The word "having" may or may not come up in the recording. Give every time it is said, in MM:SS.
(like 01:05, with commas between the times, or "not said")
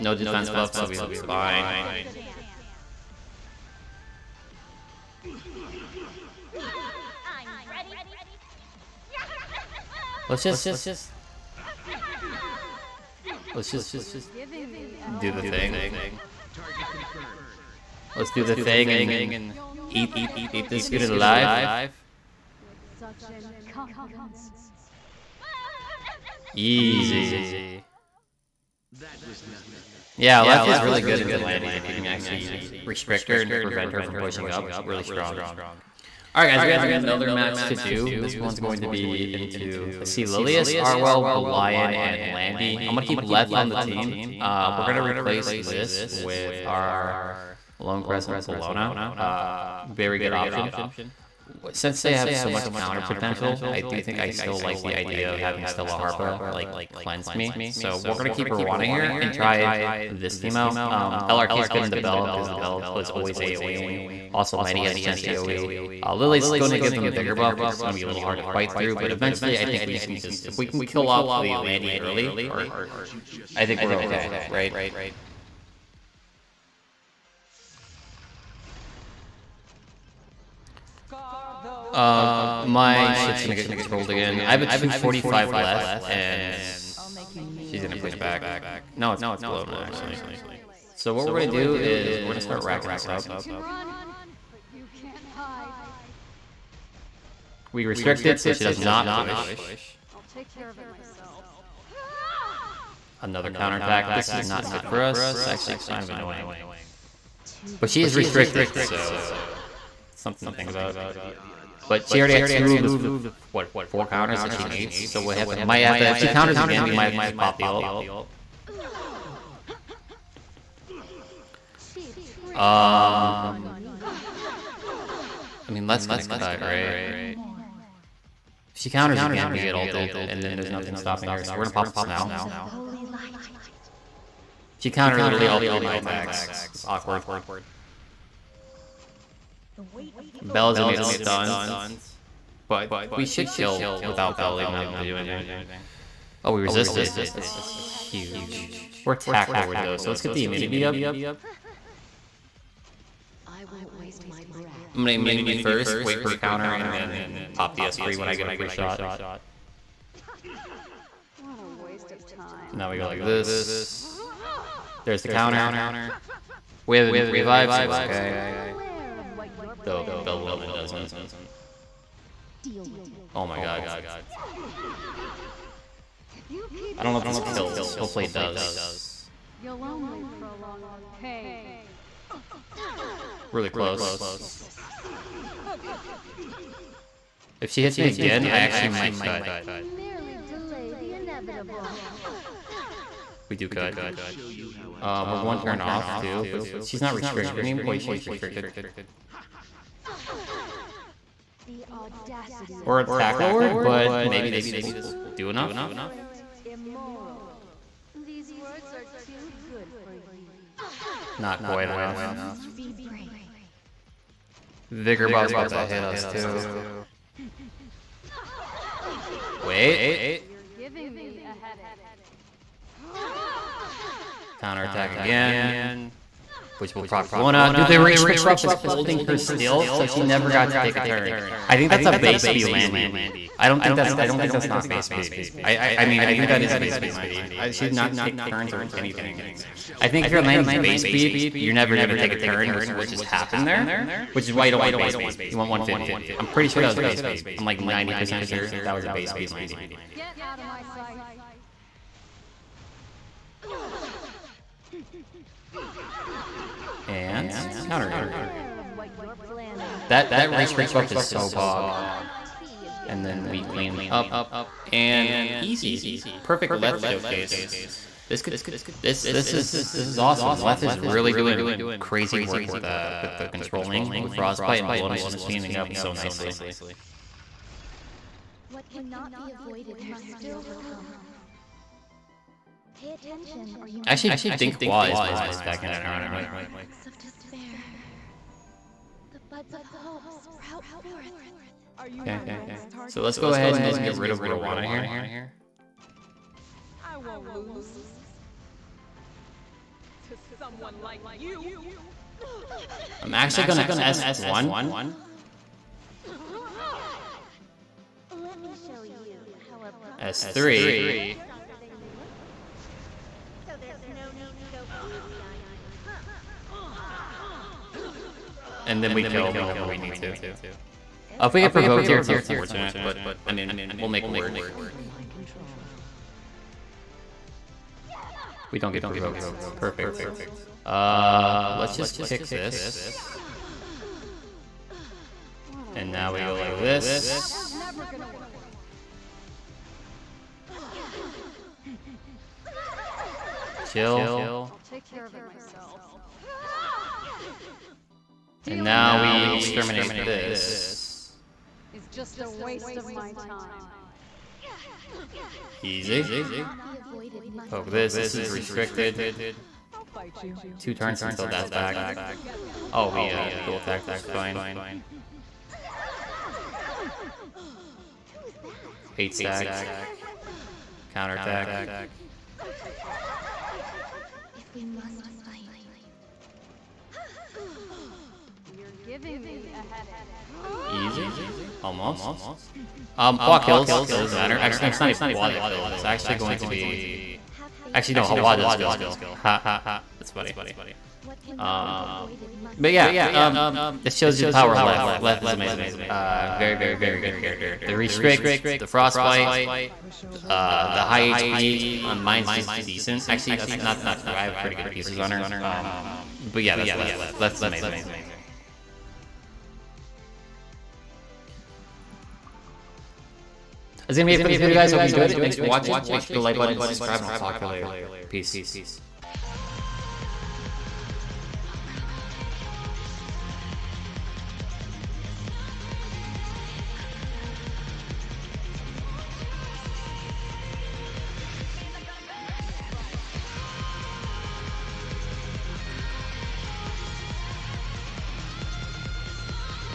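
00:55, 02:24.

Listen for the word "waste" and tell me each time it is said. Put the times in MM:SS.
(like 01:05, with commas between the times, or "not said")
02:33, 02:41, 05:52.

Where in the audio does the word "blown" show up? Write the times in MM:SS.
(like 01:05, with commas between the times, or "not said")
01:29, 04:34.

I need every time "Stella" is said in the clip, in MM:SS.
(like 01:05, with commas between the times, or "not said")
00:55.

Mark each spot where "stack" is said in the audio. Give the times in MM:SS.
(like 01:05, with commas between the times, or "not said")
06:09.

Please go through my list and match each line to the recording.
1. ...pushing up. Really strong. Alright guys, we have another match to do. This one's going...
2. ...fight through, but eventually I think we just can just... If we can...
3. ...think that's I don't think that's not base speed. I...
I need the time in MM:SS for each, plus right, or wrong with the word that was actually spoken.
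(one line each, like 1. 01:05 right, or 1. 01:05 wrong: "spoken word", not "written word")
1. 00:34 right
2. 01:08 right
3. 03:53 right.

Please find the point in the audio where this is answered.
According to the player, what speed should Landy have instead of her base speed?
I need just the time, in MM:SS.
04:05.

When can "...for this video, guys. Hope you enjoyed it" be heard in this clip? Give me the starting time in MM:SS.
06:54.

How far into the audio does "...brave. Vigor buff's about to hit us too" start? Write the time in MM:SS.
03:33.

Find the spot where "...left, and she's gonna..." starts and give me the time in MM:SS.
01:25.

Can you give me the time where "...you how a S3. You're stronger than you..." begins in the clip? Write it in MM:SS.
05:09.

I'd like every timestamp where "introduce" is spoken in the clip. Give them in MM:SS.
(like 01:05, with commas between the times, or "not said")
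not said.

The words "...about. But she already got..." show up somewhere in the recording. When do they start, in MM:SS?
01:50.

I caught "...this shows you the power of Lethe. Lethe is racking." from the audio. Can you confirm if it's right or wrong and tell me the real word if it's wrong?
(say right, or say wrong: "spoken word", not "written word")
wrong: "amazing", not "racking".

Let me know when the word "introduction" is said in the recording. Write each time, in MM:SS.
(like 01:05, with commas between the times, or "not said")
not said.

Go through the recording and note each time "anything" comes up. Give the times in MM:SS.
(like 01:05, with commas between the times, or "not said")
02:25, 03:58.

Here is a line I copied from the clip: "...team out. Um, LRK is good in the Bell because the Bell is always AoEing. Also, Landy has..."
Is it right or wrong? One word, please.
right.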